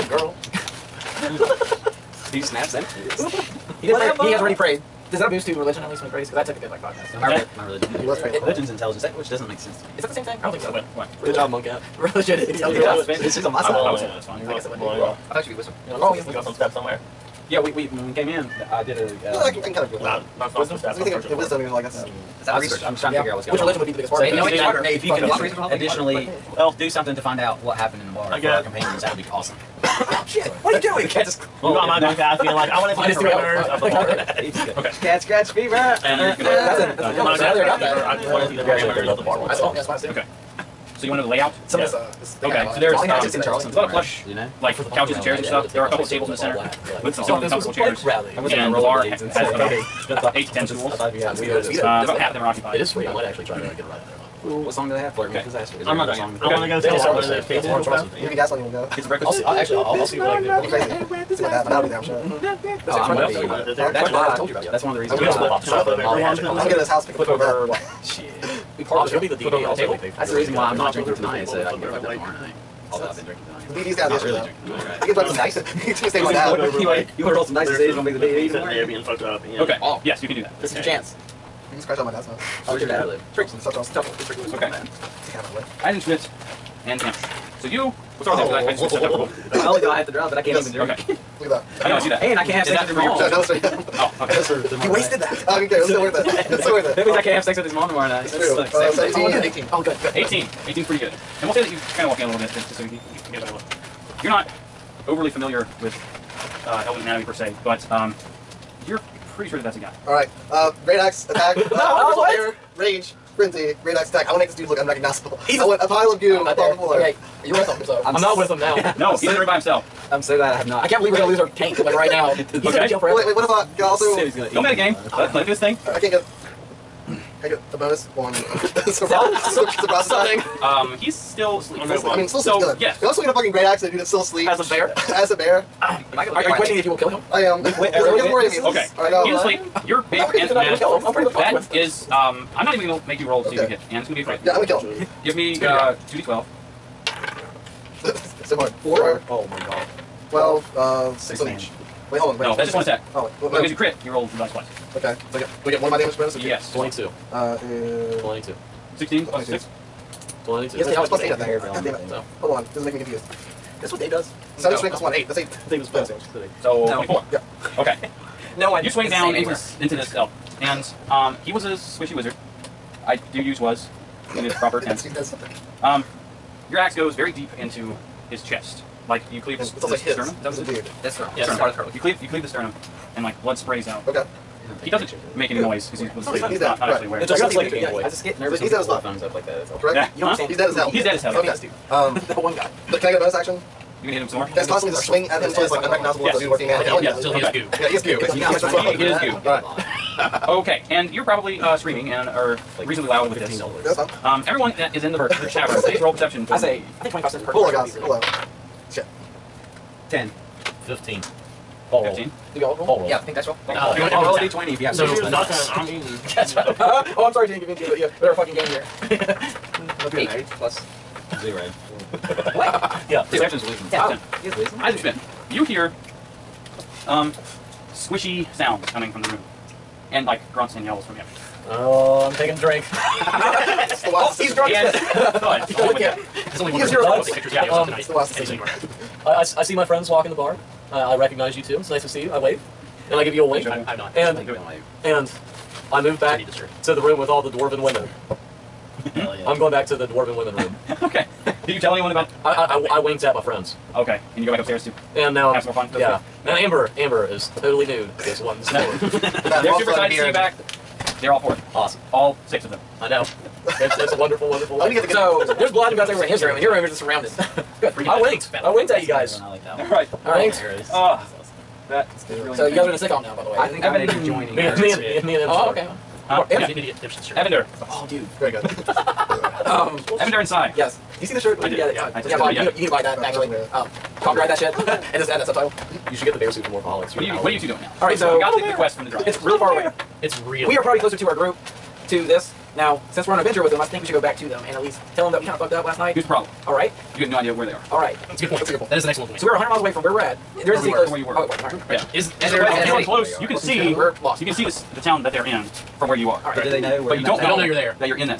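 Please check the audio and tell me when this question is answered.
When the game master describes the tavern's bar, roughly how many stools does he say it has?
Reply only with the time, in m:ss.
0:50.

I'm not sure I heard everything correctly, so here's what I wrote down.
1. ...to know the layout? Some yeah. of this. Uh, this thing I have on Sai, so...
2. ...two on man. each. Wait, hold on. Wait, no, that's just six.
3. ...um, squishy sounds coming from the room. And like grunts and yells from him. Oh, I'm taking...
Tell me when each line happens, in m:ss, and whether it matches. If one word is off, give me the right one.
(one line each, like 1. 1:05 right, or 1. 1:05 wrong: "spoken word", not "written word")
1. 0:41 wrong: "Okay", not "Sai"
2. 2:31 wrong: "six", not "two"
3. 3:47 right.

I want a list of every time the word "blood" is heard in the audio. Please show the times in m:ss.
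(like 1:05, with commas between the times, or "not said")
3:03, 4:25.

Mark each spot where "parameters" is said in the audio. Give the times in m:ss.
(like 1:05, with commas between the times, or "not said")
0:33, 0:38.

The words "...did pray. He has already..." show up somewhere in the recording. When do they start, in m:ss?
0:03.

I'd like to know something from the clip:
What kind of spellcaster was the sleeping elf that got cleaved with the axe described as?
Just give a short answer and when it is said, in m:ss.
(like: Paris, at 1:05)
squishy wizard, at 2:51.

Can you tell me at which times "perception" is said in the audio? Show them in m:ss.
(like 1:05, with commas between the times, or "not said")
3:26, 3:43.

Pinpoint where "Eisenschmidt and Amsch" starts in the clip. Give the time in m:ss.
1:25.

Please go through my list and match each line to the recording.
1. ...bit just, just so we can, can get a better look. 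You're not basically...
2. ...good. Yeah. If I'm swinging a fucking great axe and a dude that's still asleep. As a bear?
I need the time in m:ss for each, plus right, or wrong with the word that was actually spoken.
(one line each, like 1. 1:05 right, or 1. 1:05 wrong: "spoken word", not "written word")
1. 1:42 wrong: "overly", not "basically"
2. 2:12 right.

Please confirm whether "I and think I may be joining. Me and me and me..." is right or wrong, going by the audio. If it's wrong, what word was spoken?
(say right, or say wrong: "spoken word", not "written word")
right.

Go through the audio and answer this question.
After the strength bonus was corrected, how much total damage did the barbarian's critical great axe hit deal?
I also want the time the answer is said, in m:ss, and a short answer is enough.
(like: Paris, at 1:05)
24, at 2:46.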